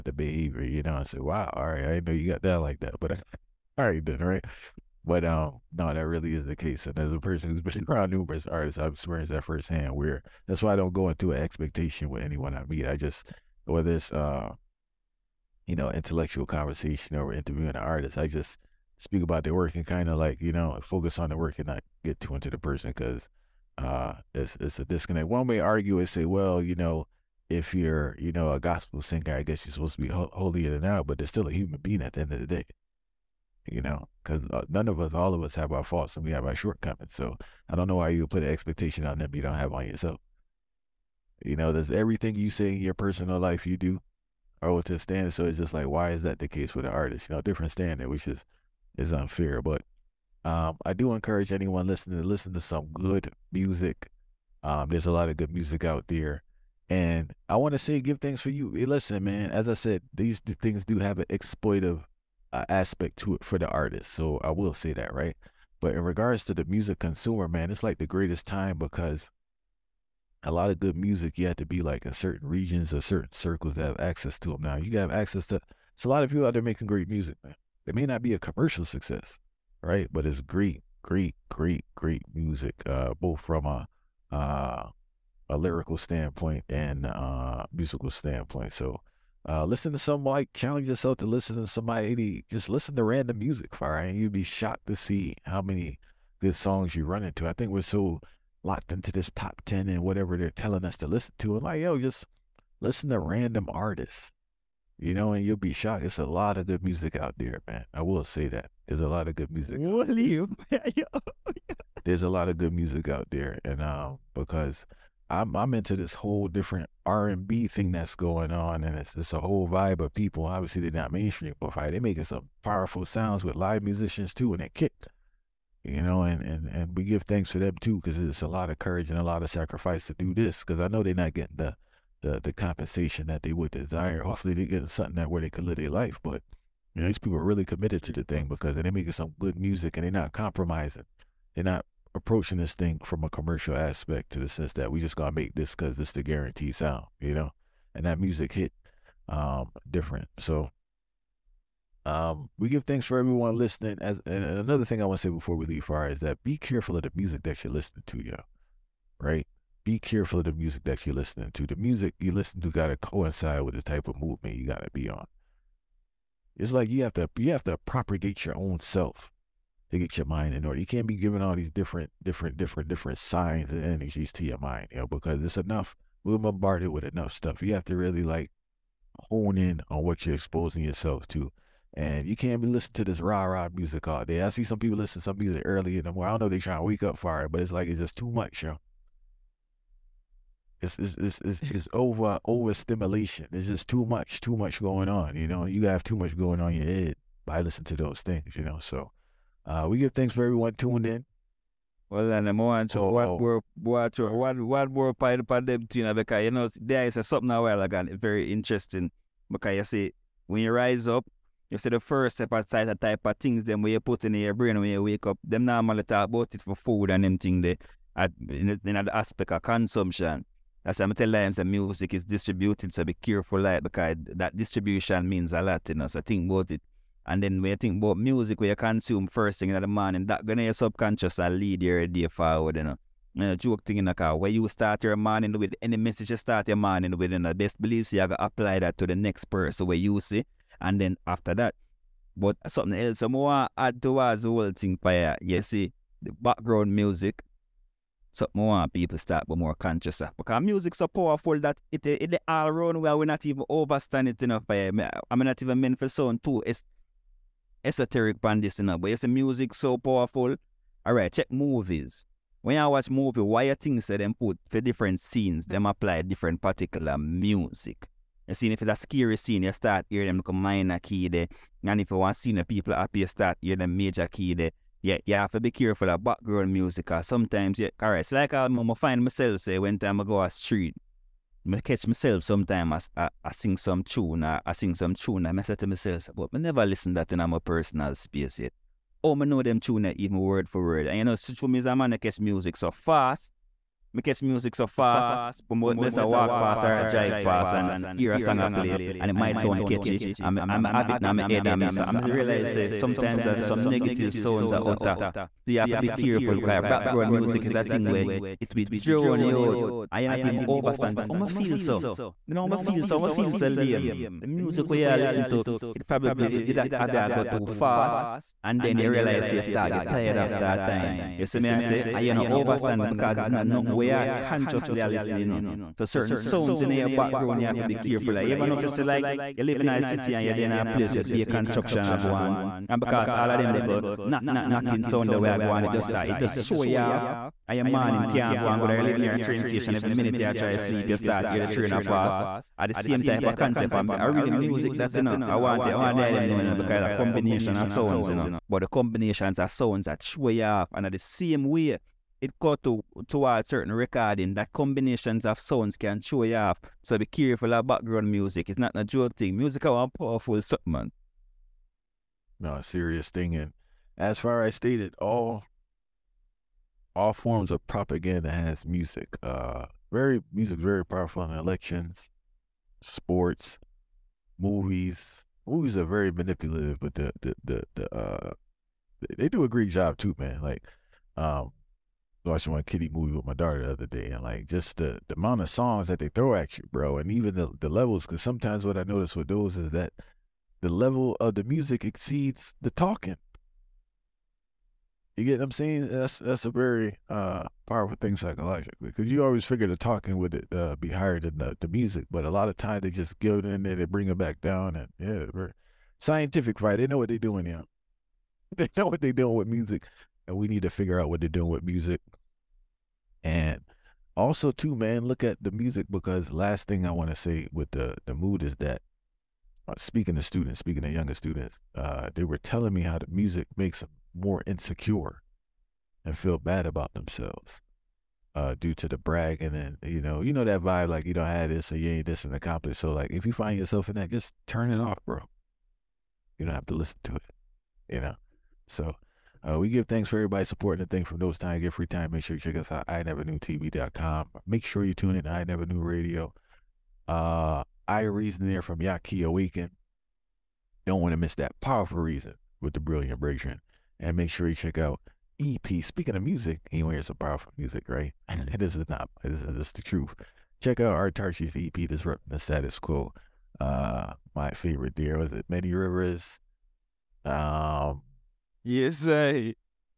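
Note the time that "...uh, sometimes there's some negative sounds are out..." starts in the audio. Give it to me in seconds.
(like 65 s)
302 s.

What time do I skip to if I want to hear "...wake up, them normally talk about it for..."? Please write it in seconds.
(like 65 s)
215 s.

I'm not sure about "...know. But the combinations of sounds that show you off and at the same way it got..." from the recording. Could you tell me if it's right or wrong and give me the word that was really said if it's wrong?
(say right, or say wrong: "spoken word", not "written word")
right.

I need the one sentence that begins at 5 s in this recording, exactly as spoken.
But um, no, that really is the case.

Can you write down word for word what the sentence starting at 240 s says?
And then after that, but something else I want to add towards the whole thing, fire.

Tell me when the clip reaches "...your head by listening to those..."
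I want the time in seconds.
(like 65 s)
196 s.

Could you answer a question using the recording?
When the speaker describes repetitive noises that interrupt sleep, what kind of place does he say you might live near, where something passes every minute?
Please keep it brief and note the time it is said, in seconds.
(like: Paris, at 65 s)
train station, at 339 s.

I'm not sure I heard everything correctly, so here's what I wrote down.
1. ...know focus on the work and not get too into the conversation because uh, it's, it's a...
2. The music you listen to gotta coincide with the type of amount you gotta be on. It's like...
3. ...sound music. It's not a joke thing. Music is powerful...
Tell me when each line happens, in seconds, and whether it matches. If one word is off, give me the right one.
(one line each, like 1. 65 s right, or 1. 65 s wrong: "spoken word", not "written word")
1. 20 s wrong: "person", not "conversation"
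2. 161 s wrong: "movement", not "amount"
3. 357 s wrong: "background", not "sound".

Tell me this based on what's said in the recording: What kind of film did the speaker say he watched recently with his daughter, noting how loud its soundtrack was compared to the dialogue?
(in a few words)
kitty movie.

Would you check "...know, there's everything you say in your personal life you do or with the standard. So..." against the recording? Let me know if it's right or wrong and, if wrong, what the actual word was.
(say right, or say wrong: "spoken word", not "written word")
right.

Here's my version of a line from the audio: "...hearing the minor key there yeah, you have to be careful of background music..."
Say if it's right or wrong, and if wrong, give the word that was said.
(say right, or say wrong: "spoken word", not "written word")
wrong: "major", not "minor".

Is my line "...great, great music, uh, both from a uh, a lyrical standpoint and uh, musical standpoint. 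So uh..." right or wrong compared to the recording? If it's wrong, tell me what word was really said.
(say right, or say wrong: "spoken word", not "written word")
right.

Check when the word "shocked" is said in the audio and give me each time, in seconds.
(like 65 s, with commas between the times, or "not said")
94 s, 105 s.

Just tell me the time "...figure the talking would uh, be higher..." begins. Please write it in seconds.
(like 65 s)
399 s.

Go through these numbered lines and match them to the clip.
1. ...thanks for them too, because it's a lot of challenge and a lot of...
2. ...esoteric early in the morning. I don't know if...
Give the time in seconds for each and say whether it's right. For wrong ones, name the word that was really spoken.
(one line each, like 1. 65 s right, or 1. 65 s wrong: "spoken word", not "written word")
1. 127 s wrong: "courage", not "challenge"
2. 185 s wrong: "music", not "esoteric".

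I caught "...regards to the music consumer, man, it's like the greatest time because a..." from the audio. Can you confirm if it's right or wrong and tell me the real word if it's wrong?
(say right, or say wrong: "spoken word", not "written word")
right.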